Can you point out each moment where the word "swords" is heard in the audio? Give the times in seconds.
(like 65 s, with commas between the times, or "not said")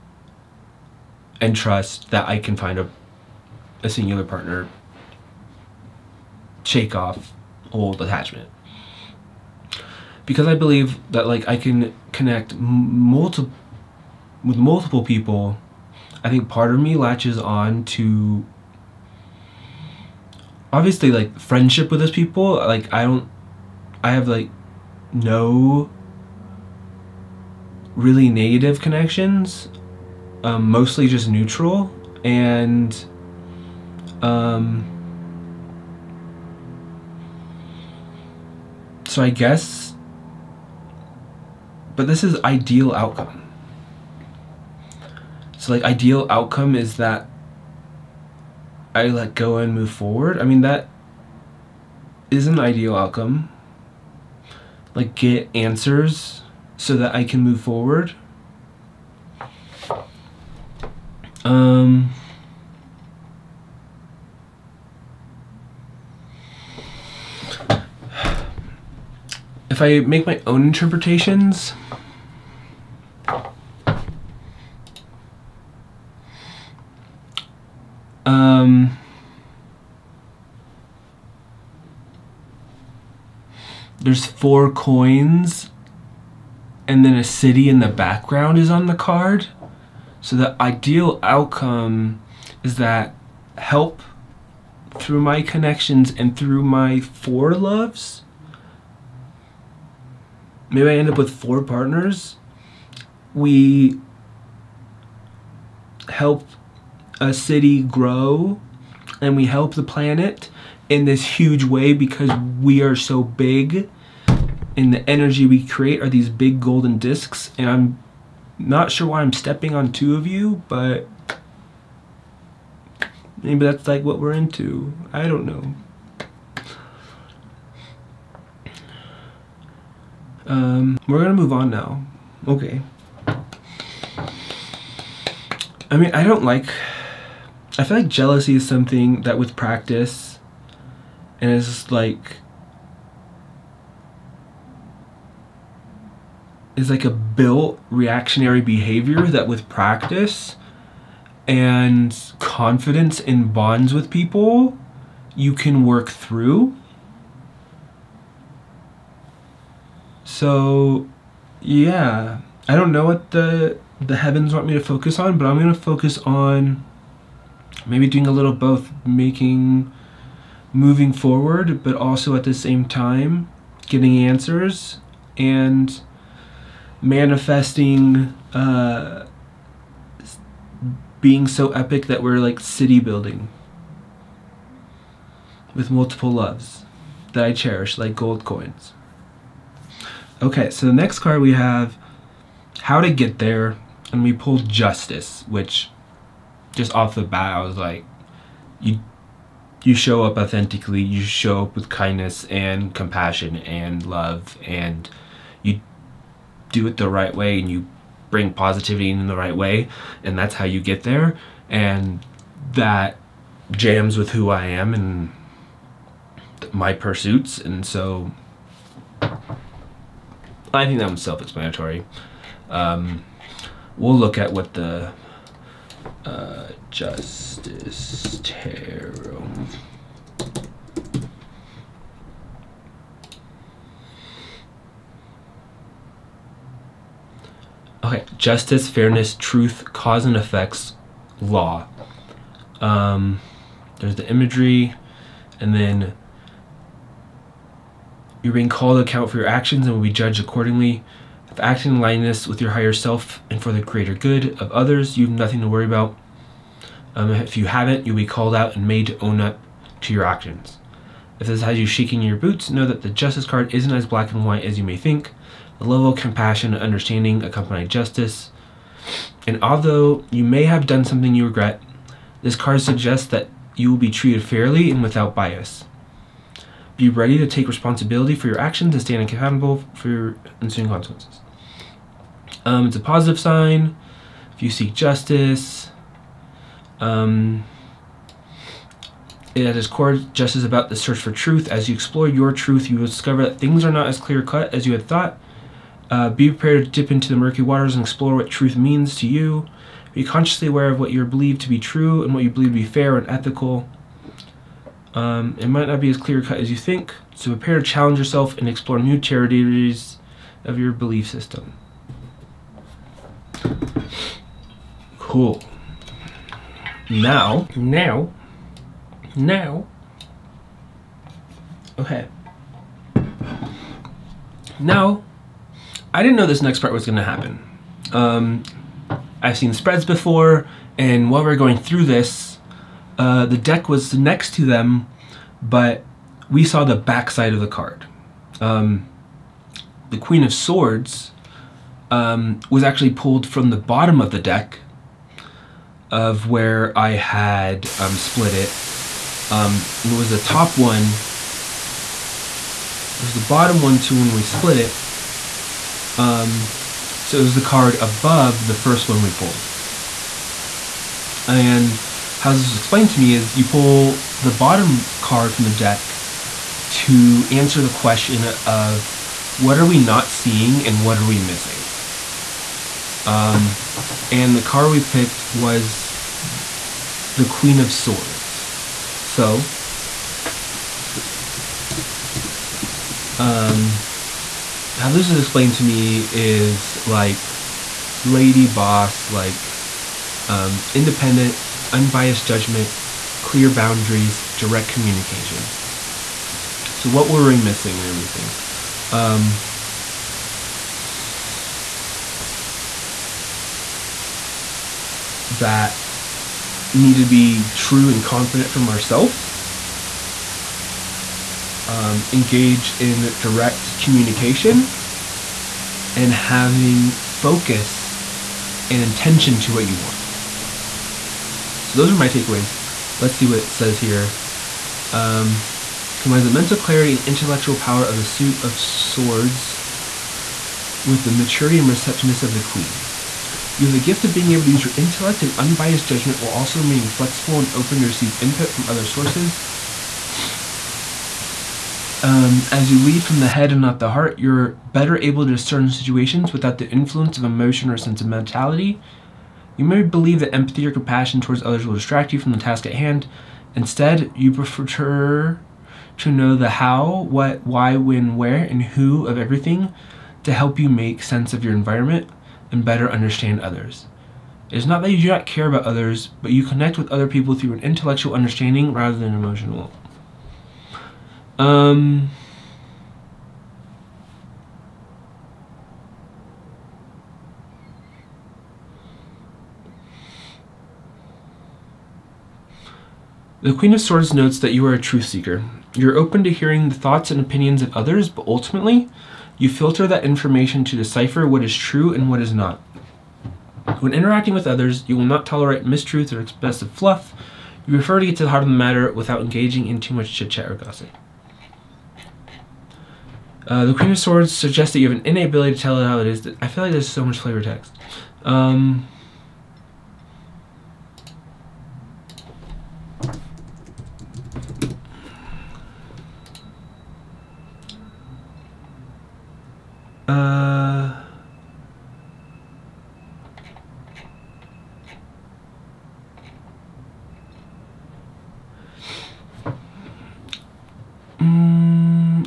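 340 s, 377 s, 428 s, 484 s, 504 s.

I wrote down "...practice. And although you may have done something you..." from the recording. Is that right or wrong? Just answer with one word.
wrong.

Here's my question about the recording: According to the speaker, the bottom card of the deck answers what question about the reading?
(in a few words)
What are we missing.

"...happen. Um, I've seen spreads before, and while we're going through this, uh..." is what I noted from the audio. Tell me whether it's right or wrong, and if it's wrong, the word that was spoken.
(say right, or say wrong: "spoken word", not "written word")
right.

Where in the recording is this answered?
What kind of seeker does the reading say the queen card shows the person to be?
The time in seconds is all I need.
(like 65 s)
484 s.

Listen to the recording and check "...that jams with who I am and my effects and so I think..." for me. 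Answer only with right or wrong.
wrong.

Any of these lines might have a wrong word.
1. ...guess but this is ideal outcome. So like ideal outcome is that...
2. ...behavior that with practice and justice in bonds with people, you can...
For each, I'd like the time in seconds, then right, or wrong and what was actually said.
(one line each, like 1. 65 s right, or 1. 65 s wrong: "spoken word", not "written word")
1. 39 s right
2. 148 s wrong: "confidence", not "justice".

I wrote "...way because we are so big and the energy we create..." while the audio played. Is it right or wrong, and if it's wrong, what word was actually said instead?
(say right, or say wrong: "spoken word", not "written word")
right.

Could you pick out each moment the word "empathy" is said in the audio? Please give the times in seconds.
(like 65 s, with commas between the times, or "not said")
450 s.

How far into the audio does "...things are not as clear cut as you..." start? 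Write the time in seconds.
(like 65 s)
293 s.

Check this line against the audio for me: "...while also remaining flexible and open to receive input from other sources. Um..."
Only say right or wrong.
right.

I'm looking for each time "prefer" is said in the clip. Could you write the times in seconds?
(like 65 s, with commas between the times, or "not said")
454 s, 497 s.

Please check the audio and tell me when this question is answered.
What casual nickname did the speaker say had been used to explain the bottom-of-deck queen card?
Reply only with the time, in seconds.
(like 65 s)
388 s.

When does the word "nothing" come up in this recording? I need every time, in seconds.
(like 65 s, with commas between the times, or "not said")
255 s.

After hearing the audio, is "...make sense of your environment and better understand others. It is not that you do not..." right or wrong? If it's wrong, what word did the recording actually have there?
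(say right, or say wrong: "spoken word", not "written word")
right.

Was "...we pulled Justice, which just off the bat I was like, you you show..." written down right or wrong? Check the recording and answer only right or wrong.
right.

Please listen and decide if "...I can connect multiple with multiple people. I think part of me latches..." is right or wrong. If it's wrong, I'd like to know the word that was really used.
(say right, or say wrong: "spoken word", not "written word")
right.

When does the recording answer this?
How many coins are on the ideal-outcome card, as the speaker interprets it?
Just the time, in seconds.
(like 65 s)
84 s.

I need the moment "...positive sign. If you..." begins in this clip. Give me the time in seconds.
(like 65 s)
283 s.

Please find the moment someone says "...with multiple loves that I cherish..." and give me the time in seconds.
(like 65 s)
185 s.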